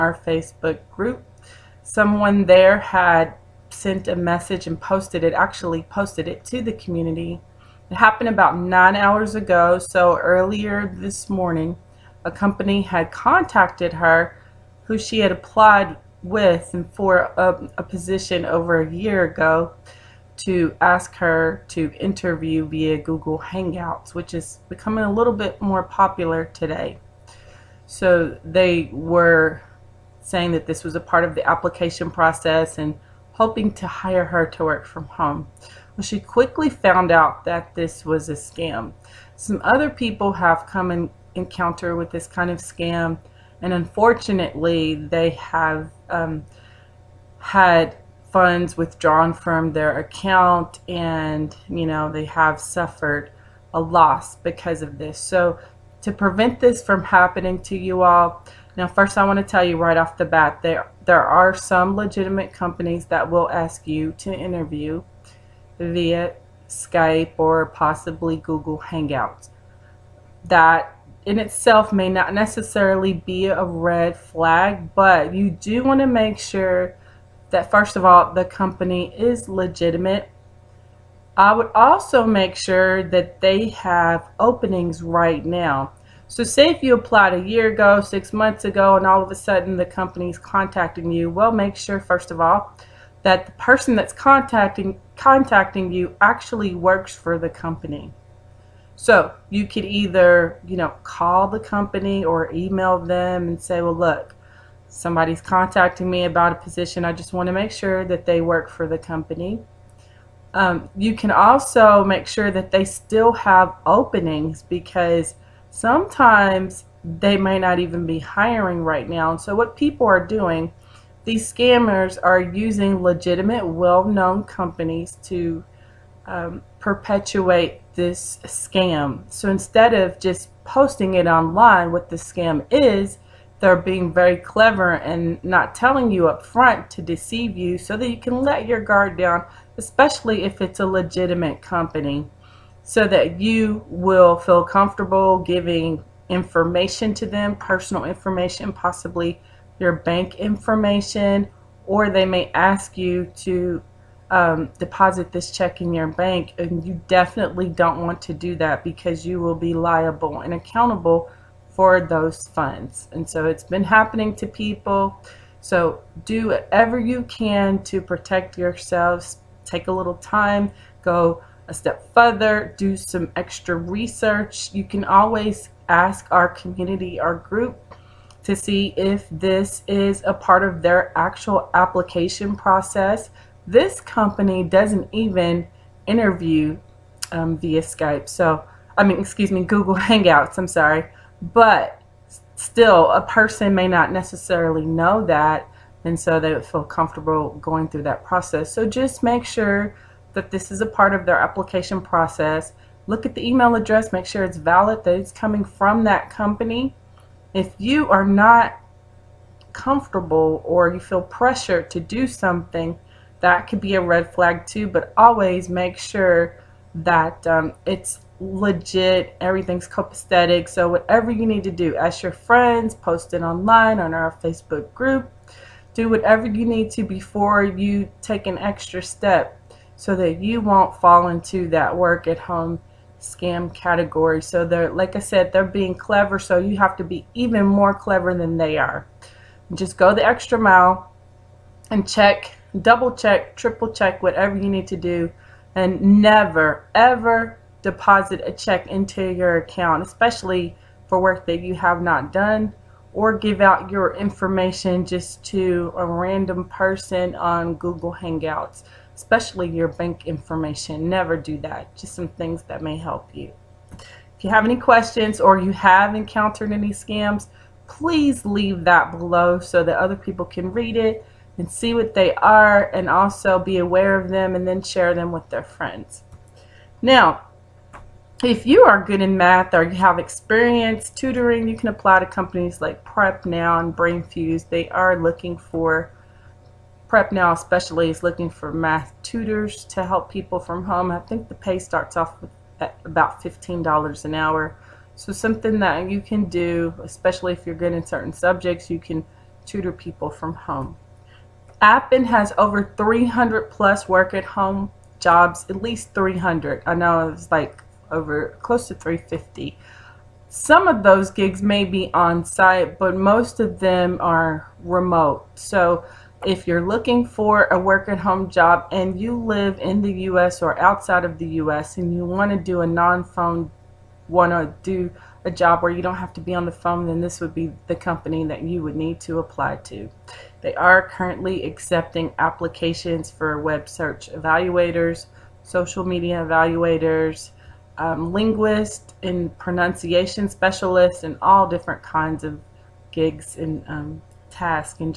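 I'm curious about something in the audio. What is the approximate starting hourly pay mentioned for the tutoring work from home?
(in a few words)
$15.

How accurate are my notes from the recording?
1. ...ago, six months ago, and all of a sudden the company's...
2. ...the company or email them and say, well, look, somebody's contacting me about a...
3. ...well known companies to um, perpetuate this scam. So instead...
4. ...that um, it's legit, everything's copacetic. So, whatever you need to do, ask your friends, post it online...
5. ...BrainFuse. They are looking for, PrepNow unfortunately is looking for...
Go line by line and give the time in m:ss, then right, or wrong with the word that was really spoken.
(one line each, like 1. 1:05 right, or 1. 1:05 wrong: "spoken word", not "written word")
1. 1:27 right
2. 1:41 right
3. 2:03 right
4. 3:36 right
5. 4:43 wrong: "especially", not "unfortunately".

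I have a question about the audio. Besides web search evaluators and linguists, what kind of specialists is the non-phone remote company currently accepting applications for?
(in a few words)
Pronunciation specialists.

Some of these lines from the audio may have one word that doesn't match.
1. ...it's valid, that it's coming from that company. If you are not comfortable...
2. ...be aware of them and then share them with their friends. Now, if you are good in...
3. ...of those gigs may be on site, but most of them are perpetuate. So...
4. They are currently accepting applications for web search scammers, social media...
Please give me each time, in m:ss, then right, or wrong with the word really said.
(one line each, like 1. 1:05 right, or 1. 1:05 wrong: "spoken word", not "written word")
1. 3:24 right
2. 4:33 right
3. 5:10 wrong: "remote", not "perpetuate"
4. 5:30 wrong: "evaluators", not "scammers".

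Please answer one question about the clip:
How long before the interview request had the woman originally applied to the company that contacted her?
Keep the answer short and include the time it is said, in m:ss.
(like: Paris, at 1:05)
Over a year ago, at 0:18.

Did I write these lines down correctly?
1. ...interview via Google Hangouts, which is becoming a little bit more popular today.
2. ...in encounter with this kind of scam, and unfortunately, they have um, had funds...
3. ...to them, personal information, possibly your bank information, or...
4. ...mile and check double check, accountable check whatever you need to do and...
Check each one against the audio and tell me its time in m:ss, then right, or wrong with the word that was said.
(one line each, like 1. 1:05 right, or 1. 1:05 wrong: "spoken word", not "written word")
1. 0:22 right
2. 0:40 right
3. 2:27 right
4. 4:00 wrong: "triple", not "accountable".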